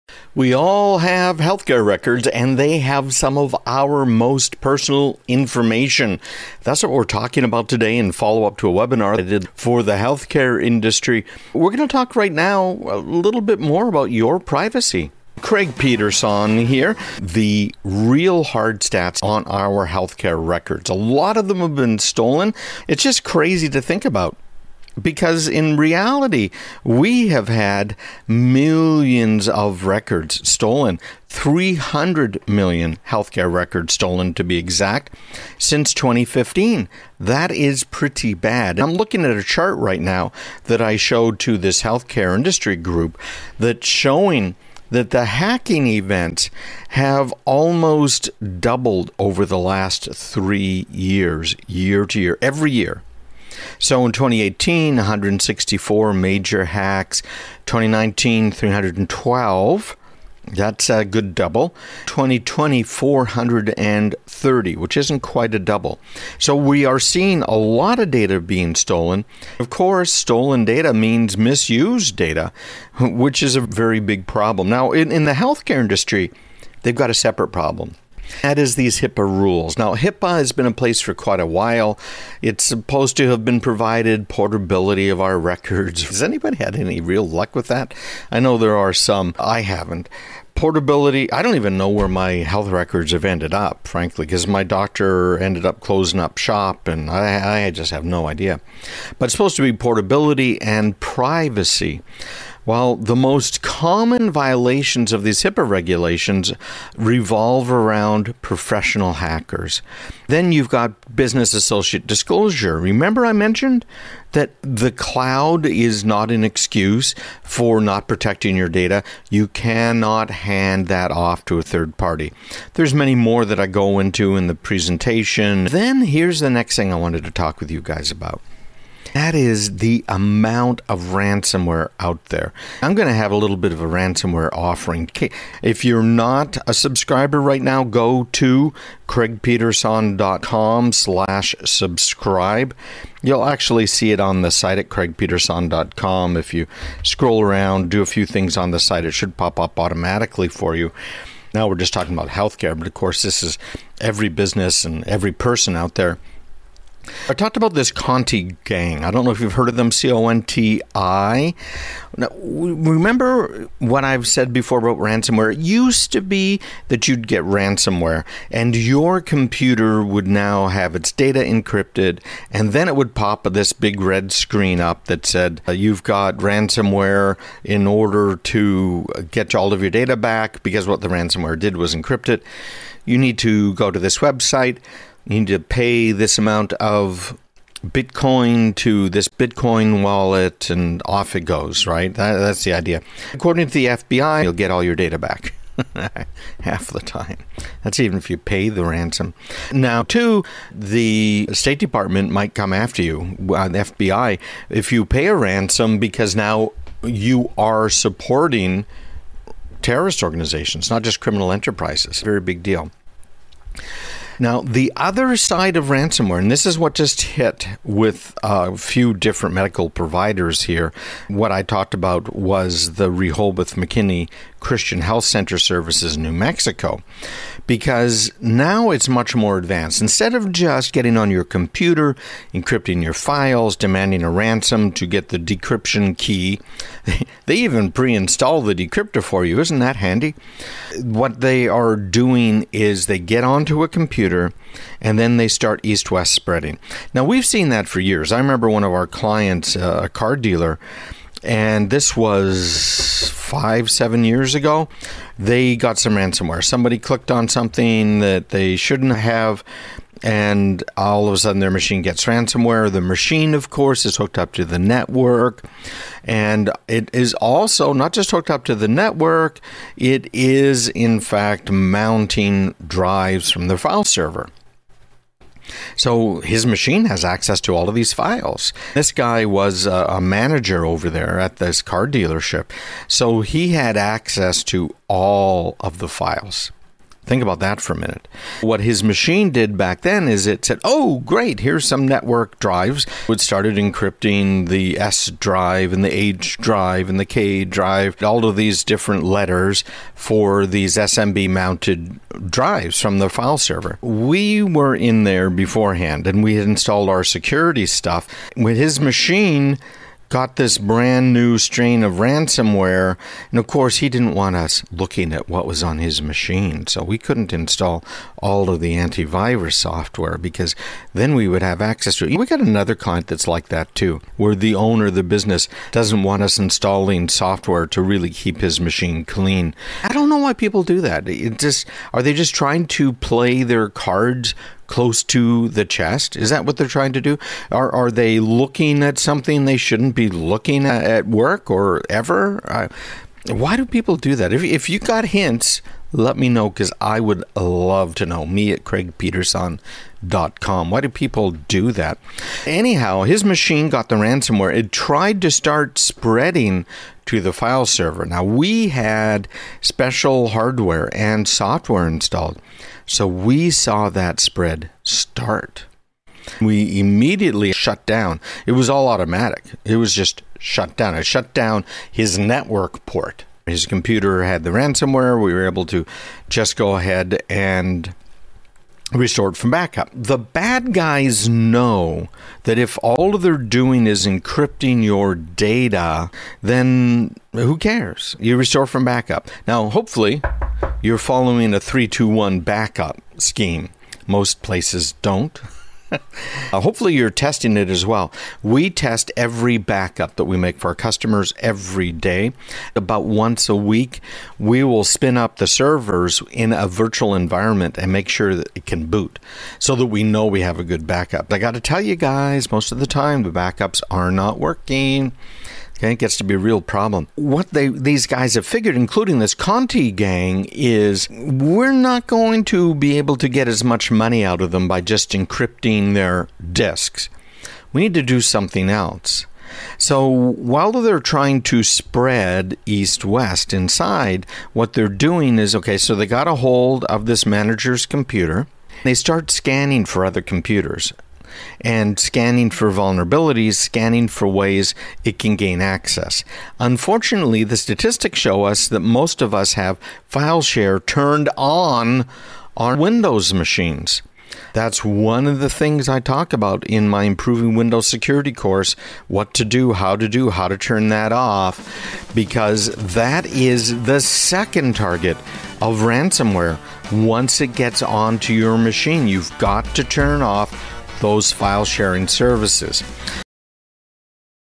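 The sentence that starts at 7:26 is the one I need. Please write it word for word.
Unfortunately, the statistics show us that most of us have file share turned on on Windows machines.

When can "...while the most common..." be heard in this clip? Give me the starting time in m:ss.
1:42.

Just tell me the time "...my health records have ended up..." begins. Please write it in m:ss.
1:32.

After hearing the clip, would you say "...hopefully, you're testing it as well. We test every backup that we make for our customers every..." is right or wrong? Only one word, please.
right.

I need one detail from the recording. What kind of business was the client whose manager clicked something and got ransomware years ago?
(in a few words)
car dealer.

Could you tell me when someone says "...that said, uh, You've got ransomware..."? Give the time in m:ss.
2:55.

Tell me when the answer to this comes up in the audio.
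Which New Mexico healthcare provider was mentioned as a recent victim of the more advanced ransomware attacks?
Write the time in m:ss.
3:43.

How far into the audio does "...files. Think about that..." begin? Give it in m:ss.
4:46.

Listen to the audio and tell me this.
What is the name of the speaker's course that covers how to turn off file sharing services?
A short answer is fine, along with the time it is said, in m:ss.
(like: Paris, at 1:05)
Improving Windows Security, at 7:37.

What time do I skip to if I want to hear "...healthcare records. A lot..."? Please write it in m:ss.
0:19.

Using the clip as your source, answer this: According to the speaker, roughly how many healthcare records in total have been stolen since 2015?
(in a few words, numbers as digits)
300 million.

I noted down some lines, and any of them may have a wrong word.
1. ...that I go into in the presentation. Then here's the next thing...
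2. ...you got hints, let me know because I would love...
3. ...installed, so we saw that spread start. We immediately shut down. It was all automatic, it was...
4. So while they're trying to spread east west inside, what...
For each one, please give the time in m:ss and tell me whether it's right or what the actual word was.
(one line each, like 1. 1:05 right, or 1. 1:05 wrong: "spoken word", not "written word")
1. 2:03 right
2. 5:44 right
3. 6:02 right
4. 7:09 right.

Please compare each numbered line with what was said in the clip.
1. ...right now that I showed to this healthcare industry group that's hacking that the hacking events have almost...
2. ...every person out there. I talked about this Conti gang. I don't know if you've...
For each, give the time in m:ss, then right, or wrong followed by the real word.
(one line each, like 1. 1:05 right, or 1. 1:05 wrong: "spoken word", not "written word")
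1. 0:39 wrong: "showing", not "hacking"
2. 2:35 right.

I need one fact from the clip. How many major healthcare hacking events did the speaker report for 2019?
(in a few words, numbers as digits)
312.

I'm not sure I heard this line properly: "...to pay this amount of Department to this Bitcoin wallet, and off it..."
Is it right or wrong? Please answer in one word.
wrong.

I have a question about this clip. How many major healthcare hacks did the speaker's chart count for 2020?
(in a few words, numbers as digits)
430.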